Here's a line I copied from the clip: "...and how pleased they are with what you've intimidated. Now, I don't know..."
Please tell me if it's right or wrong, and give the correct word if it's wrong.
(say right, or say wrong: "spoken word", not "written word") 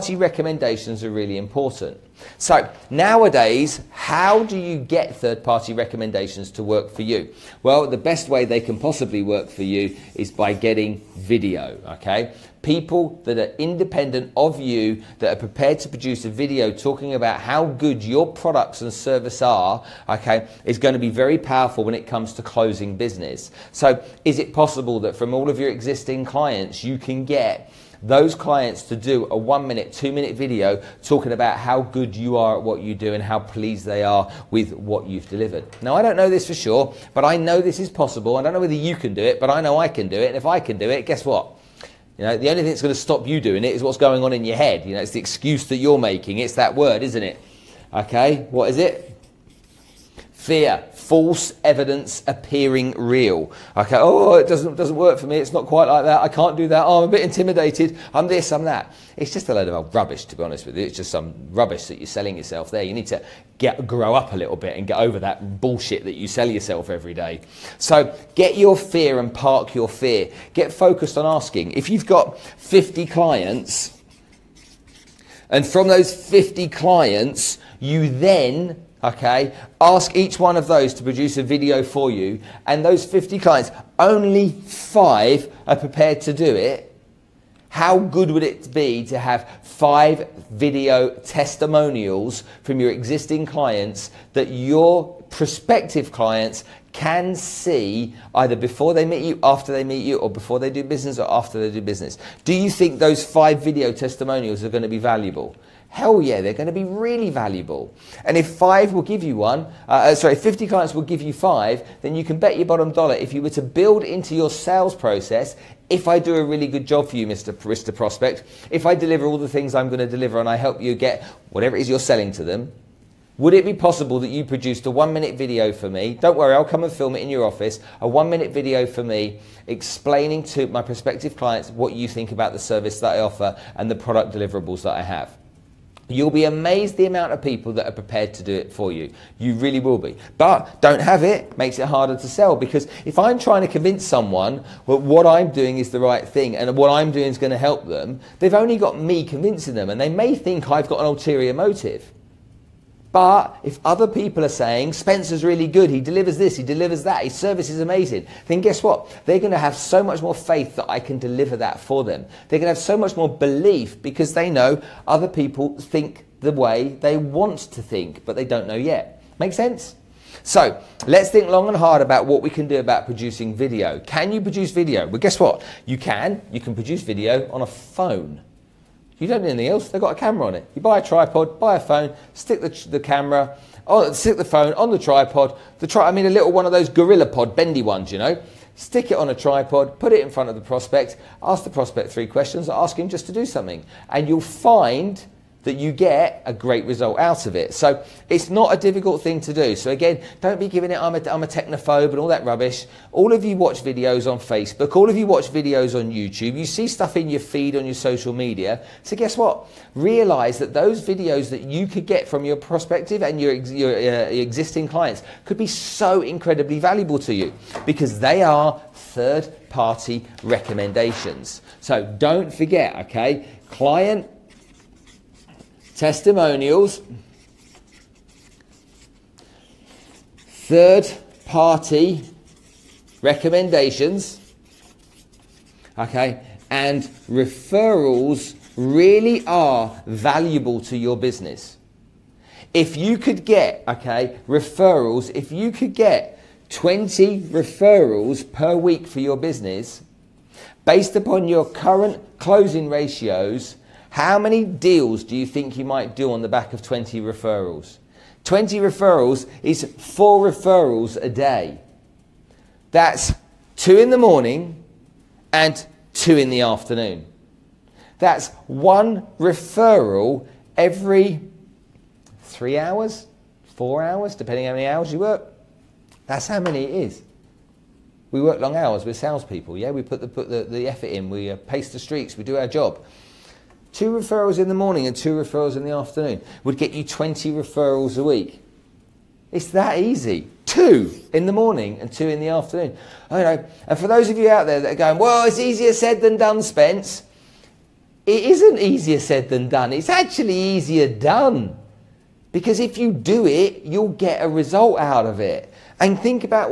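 wrong: "delivered", not "intimidated".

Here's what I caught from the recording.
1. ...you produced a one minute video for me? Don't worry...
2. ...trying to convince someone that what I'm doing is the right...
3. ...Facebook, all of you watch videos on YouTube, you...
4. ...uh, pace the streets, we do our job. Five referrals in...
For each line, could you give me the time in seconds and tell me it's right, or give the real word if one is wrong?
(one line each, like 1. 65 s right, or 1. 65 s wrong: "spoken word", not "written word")
1. 124 s right
2. 143 s right
3. 204 s right
4. 281 s wrong: "Two", not "Five".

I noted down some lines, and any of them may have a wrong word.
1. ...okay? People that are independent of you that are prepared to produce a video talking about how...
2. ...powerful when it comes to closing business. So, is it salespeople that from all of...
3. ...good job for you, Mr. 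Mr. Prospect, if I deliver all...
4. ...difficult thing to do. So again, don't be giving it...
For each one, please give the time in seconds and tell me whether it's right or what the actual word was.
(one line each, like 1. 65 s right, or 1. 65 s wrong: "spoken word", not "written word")
1. 11 s right
2. 21 s wrong: "possible", not "salespeople"
3. 116 s right
4. 198 s right.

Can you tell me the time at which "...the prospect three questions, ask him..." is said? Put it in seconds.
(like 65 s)
191 s.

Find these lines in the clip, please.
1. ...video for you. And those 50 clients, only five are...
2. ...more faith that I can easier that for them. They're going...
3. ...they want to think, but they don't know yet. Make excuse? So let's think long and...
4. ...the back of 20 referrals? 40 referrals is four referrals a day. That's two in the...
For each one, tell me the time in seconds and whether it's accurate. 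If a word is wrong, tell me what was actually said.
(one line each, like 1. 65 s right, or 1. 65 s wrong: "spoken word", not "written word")
1. 81 s right
2. 160 s wrong: "deliver", not "easier"
3. 166 s wrong: "sense", not "excuse"
4. 256 s wrong: "20", not "40".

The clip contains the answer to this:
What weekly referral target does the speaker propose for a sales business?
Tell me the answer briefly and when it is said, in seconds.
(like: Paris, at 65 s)
20, at 246 s.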